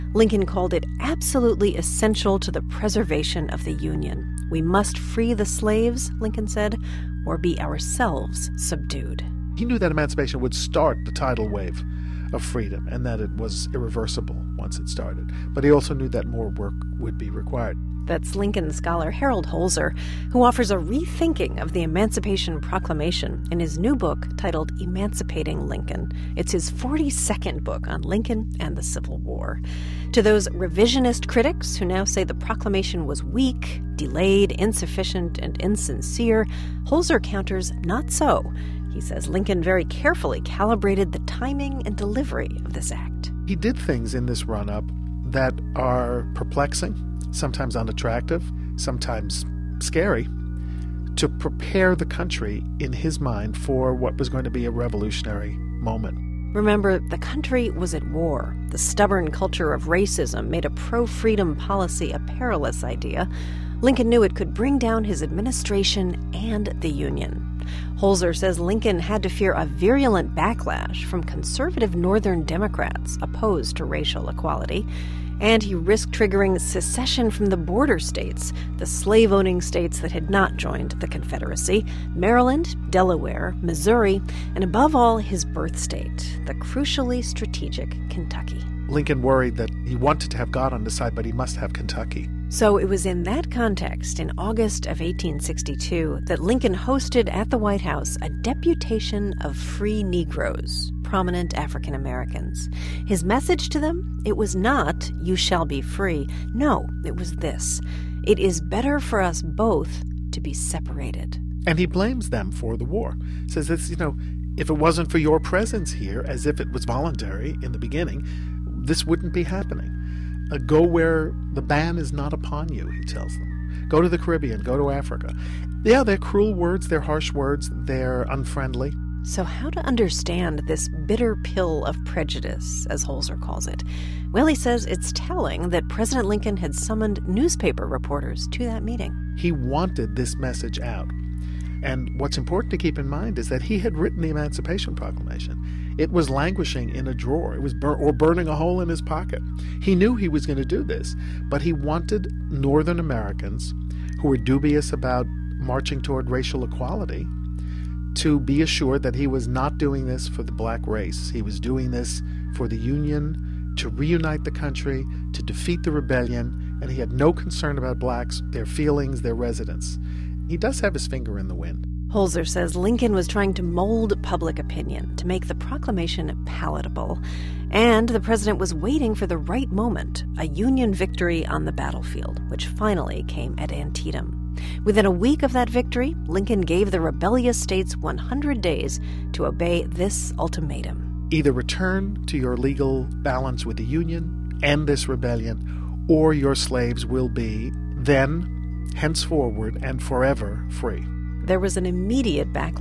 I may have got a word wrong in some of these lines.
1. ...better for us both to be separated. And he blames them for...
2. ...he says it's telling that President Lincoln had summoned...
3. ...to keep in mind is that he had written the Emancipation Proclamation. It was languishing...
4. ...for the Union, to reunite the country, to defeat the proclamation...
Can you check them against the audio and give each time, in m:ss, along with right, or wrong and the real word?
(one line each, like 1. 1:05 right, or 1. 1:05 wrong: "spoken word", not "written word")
1. 1:48 right
2. 2:14 right
3. 2:22 right
4. 2:42 wrong: "rebellion", not "proclamation".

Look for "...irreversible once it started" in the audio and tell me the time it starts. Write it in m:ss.
0:13.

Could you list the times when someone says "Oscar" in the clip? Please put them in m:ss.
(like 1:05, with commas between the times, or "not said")
not said.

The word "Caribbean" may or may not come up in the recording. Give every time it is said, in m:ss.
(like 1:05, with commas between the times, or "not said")
2:04.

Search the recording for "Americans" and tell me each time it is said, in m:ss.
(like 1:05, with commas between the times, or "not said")
1:41, 2:32.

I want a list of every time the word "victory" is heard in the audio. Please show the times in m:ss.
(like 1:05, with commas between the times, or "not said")
3:00, 3:05.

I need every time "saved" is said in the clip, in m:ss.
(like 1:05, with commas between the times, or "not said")
not said.